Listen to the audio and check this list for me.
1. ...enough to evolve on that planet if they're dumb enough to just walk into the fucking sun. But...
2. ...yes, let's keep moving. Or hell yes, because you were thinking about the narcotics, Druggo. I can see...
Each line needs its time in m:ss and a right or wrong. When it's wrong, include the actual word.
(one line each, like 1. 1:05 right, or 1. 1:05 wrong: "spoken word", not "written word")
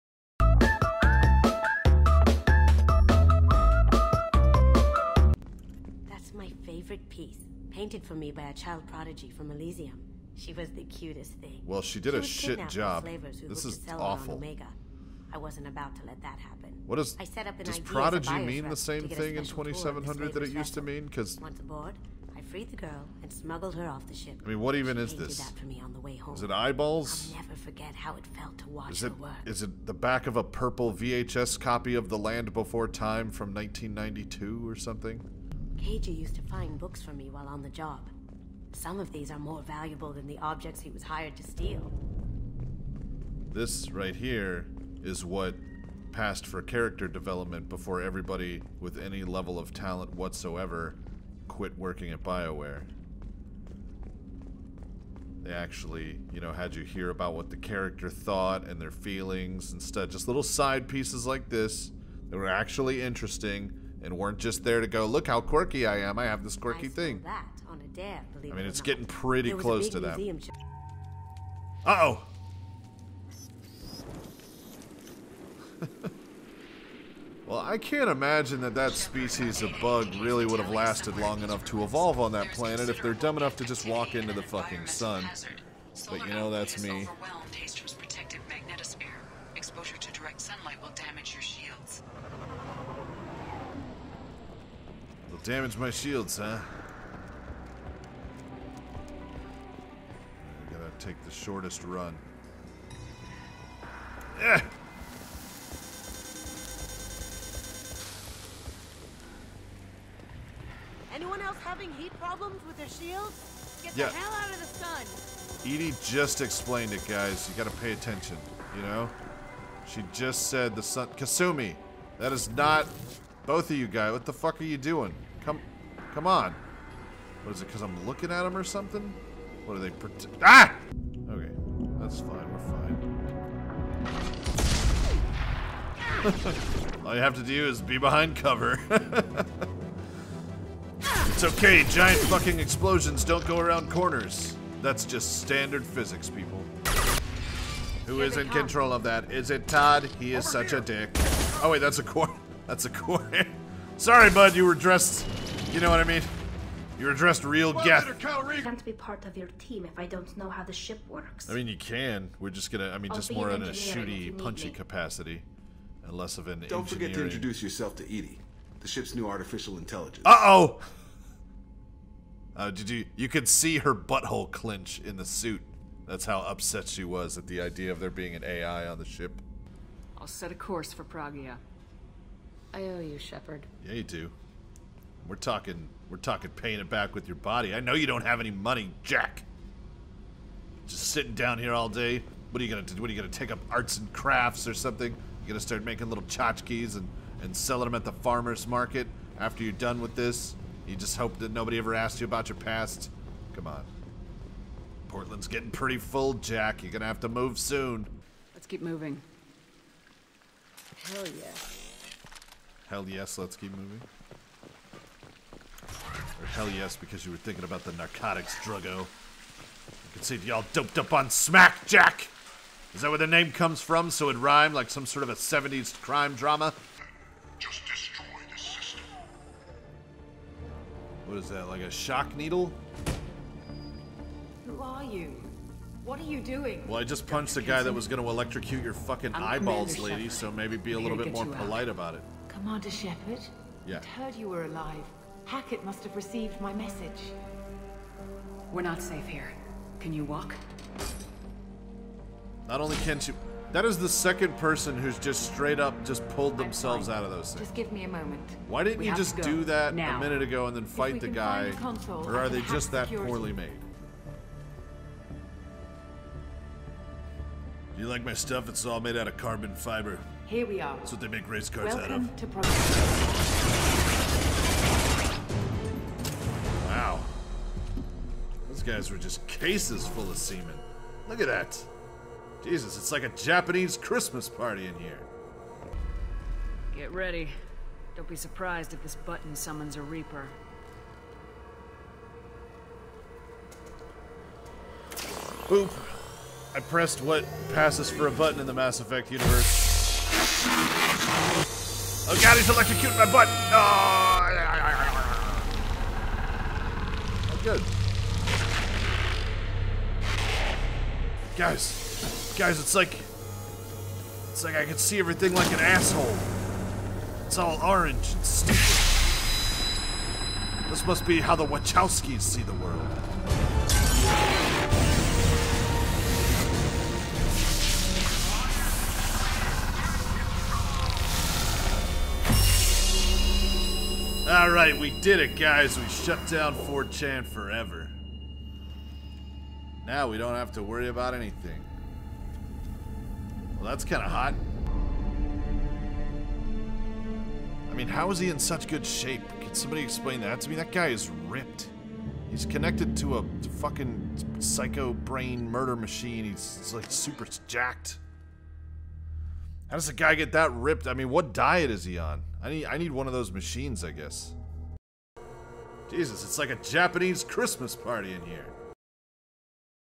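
1. 1:21 right
2. 3:33 right.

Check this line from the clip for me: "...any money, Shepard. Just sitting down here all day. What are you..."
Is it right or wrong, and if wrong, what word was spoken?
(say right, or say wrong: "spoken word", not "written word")
wrong: "Jack", not "Shepard".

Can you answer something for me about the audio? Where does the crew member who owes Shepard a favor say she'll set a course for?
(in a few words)
Pragia.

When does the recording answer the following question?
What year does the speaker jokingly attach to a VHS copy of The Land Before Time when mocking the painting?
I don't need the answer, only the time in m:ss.
0:33.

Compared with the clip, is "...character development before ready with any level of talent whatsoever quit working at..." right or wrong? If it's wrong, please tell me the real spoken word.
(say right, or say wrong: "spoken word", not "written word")
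wrong: "everybody", not "ready".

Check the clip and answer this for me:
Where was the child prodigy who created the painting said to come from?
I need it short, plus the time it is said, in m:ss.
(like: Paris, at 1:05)
Elysium, at 0:09.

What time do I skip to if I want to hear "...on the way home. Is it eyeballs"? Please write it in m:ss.
0:25.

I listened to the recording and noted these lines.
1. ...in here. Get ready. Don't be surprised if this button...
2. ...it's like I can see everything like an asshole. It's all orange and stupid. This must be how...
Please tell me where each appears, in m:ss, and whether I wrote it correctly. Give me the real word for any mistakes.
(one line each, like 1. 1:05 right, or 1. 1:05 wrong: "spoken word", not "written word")
1. 4:44 right
2. 5:14 right.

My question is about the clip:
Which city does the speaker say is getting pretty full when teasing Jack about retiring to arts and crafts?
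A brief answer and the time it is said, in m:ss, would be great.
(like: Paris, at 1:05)
Portland, at 3:25.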